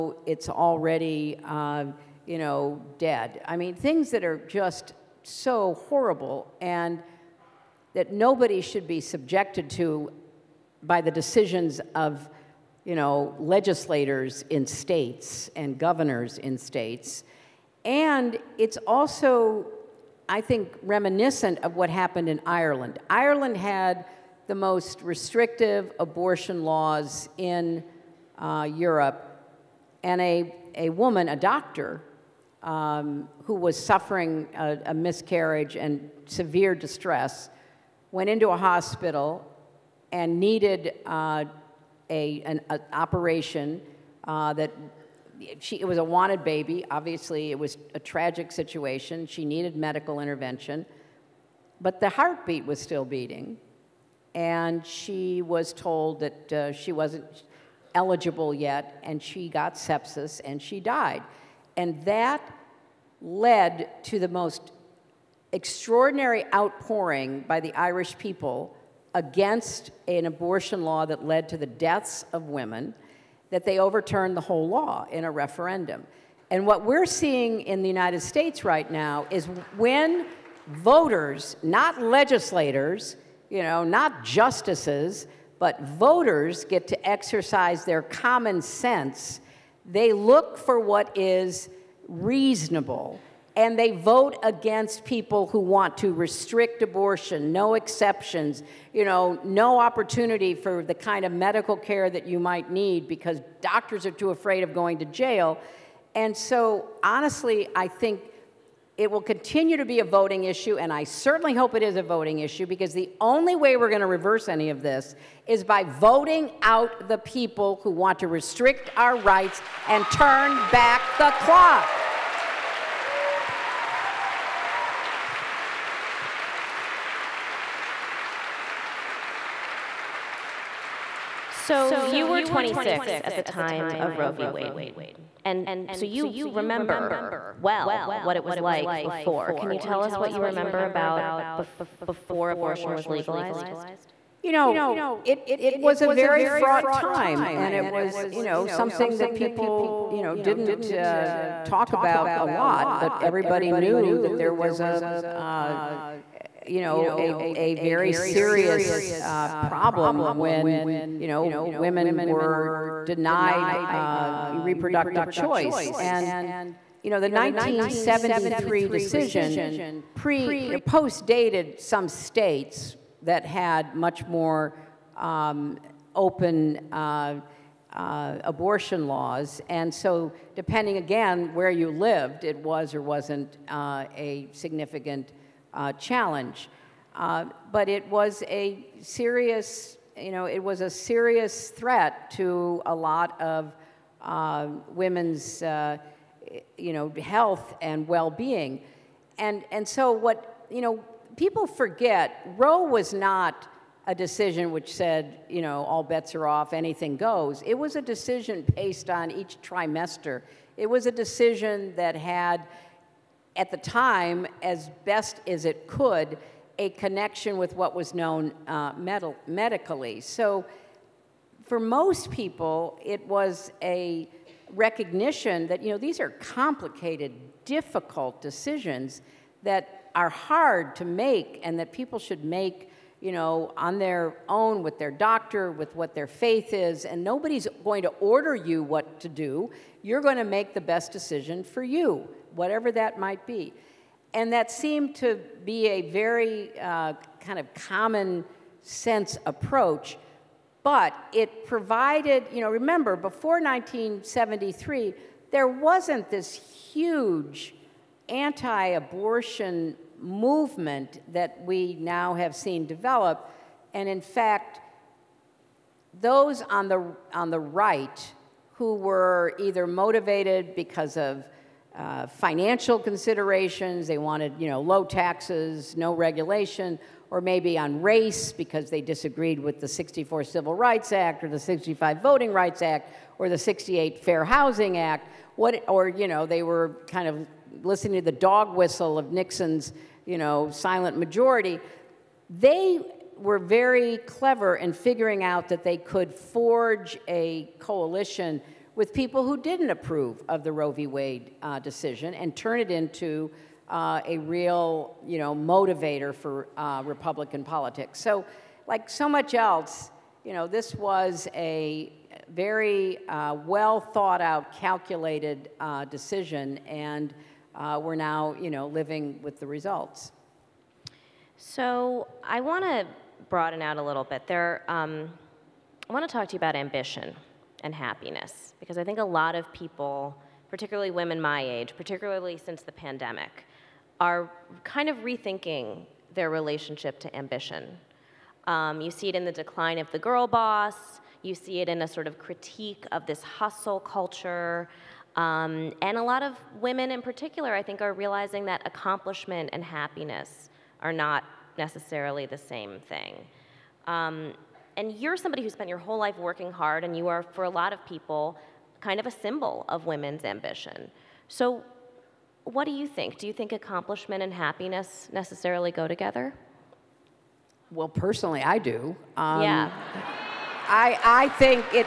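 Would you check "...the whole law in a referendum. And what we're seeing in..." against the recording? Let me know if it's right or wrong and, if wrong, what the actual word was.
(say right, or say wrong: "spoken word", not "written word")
right.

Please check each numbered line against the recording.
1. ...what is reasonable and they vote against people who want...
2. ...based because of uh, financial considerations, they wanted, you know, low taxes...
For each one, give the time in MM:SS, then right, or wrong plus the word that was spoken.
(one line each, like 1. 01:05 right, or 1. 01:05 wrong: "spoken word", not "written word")
1. 01:30 right
2. 04:29 wrong: "motivated", not "based".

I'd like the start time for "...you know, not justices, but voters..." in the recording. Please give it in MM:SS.
01:23.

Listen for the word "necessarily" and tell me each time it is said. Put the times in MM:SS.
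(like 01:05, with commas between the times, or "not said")
05:51, 06:05.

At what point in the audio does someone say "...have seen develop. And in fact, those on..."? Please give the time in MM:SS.
04:22.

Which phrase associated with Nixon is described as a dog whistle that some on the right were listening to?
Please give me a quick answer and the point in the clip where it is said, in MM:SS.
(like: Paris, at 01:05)
silent majority, at 04:50.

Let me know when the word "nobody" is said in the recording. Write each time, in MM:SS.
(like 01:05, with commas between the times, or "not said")
00:08, 03:57.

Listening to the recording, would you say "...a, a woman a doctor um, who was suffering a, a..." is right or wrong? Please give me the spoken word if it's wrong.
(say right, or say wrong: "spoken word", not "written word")
right.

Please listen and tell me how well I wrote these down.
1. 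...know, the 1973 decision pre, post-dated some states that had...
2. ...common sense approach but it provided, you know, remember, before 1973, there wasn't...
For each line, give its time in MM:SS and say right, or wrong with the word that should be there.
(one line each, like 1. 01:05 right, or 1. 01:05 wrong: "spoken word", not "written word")
1. 02:47 right
2. 04:07 right.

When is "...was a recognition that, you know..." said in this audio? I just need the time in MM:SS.
03:43.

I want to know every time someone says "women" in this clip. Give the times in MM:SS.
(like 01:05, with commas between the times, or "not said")
01:12, 02:41, 03:14, 05:31, 05:46, 06:00.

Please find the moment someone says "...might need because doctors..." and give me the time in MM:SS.
01:42.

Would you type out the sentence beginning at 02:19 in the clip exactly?
Can you tell us what you remember about bef before abortion was legalized?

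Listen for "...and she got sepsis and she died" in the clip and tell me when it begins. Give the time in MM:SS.
00:59.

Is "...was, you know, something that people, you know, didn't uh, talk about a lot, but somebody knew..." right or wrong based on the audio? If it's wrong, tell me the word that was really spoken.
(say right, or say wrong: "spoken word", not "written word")
wrong: "everybody", not "somebody".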